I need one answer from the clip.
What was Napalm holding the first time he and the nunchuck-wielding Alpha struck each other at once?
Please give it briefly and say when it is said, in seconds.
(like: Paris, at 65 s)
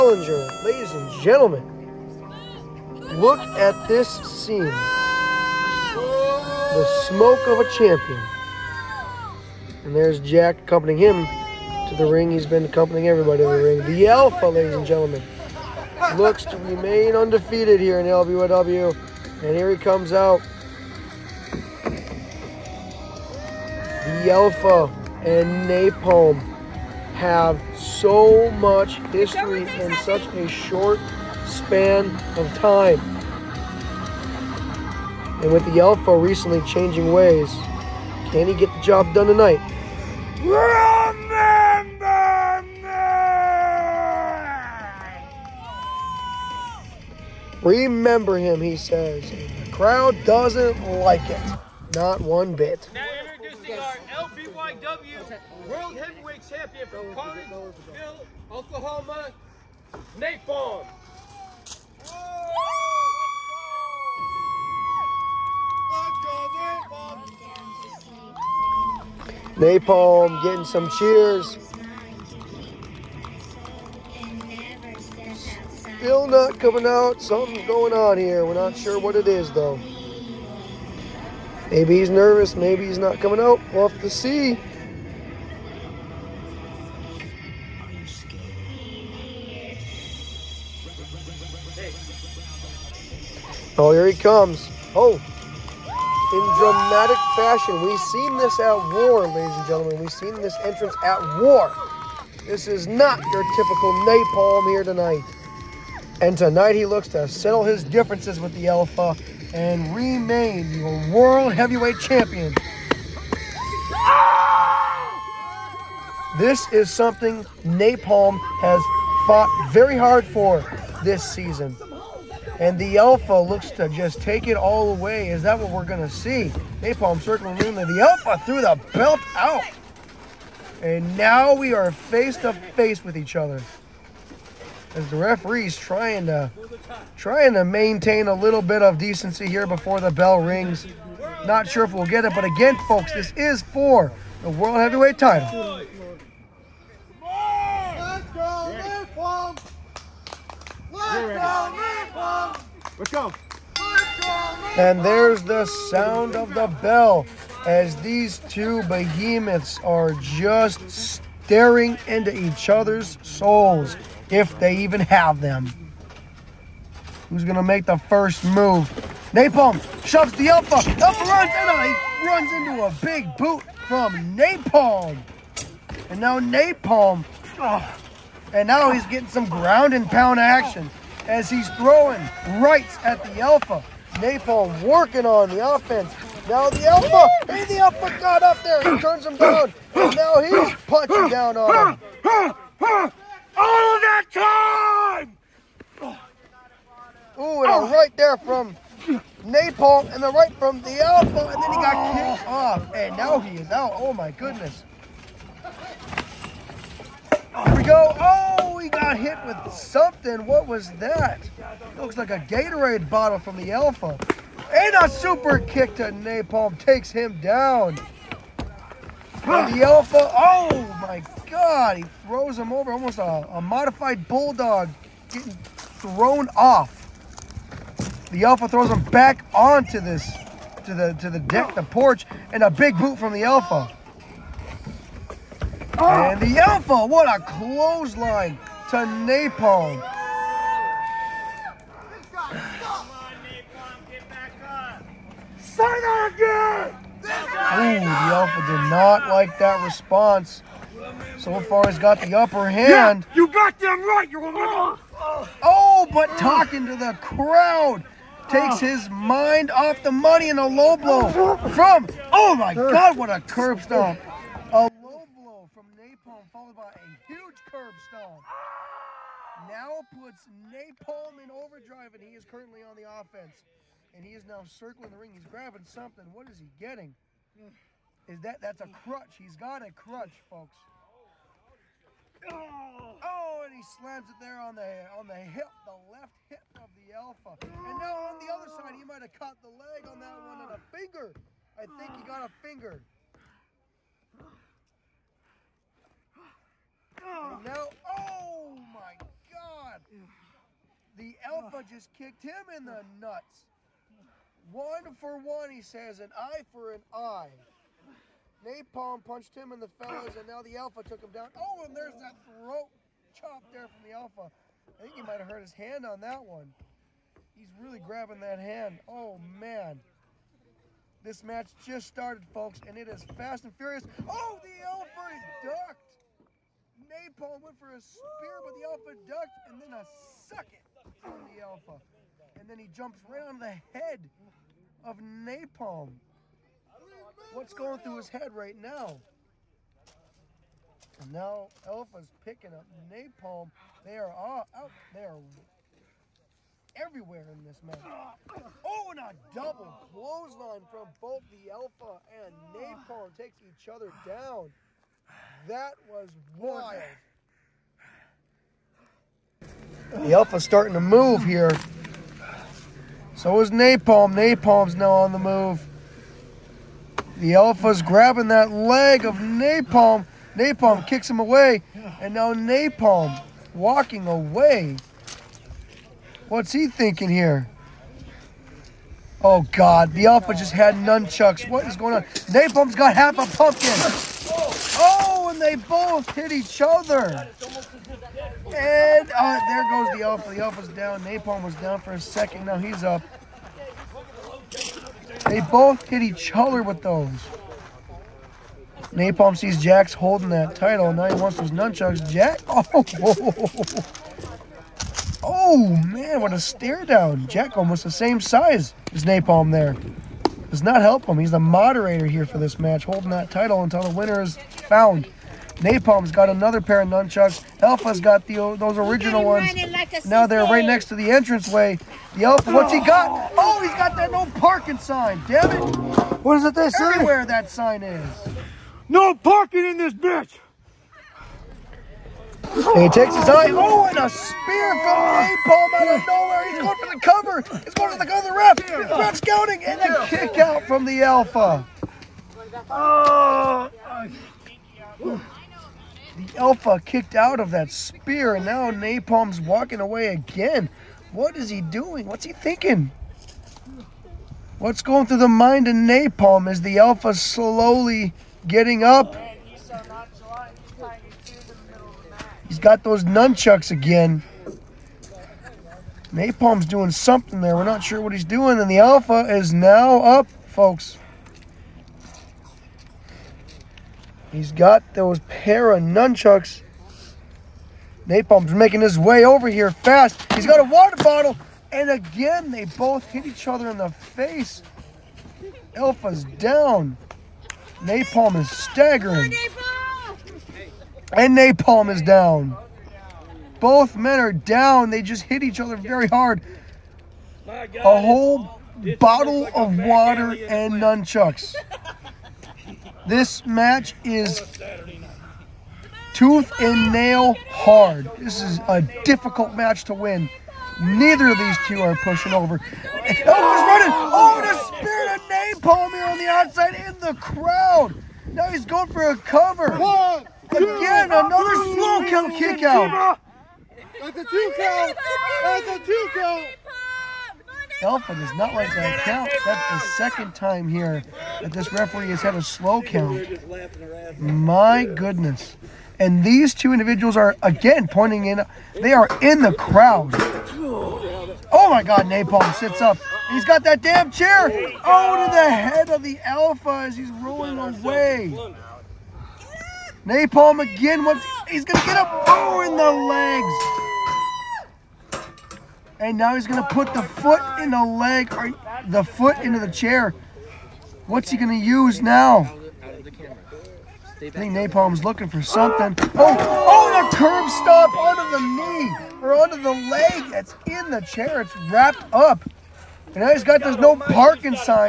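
Half a pumpkin, at 383 s.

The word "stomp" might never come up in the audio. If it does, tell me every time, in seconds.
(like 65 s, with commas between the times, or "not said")
263 s, 268 s.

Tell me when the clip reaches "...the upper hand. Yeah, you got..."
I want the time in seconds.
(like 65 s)
252 s.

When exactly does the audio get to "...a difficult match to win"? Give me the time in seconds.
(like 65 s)
508 s.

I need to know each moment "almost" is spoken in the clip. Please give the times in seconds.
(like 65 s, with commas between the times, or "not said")
222 s, 407 s.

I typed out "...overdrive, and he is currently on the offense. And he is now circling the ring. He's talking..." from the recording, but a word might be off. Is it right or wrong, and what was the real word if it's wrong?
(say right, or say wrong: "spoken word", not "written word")
wrong: "grabbing", not "talking".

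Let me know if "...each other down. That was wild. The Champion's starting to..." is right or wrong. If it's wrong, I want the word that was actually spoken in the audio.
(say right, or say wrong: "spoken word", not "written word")
wrong: "Alpha", not "Champion".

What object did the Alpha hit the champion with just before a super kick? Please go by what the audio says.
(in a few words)
Gatorade bottle.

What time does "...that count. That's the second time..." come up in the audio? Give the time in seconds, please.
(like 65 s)
528 s.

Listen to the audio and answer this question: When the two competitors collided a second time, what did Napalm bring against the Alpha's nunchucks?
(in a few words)
A water bottle.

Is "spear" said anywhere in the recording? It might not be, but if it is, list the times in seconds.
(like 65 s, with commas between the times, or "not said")
328 s, 434 s, 447 s.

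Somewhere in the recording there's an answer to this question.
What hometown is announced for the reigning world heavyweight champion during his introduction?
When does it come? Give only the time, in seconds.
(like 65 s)
57 s.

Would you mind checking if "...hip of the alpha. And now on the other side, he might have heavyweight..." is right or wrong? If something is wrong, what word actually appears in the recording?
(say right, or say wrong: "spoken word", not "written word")
wrong: "caught", not "heavyweight".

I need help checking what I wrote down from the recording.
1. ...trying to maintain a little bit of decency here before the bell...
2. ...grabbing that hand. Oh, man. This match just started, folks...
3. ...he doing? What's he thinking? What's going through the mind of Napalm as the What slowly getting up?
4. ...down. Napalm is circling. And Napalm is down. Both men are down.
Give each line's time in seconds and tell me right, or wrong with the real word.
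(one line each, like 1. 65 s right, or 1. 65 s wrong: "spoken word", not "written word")
1. 137 s right
2. 318 s right
3. 451 s wrong: "Alpha", not "What"
4. 486 s wrong: "staggering", not "circling".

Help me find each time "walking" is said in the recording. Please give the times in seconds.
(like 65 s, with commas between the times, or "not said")
373 s, 449 s.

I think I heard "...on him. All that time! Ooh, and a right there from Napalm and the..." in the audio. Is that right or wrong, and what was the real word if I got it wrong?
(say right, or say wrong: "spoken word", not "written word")
right.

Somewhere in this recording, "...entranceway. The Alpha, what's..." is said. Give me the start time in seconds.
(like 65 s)
421 s.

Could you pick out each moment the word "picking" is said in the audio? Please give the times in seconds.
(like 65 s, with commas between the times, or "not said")
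342 s.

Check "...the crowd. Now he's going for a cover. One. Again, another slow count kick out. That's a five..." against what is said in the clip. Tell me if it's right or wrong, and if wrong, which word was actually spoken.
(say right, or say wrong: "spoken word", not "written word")
wrong: "two", not "five".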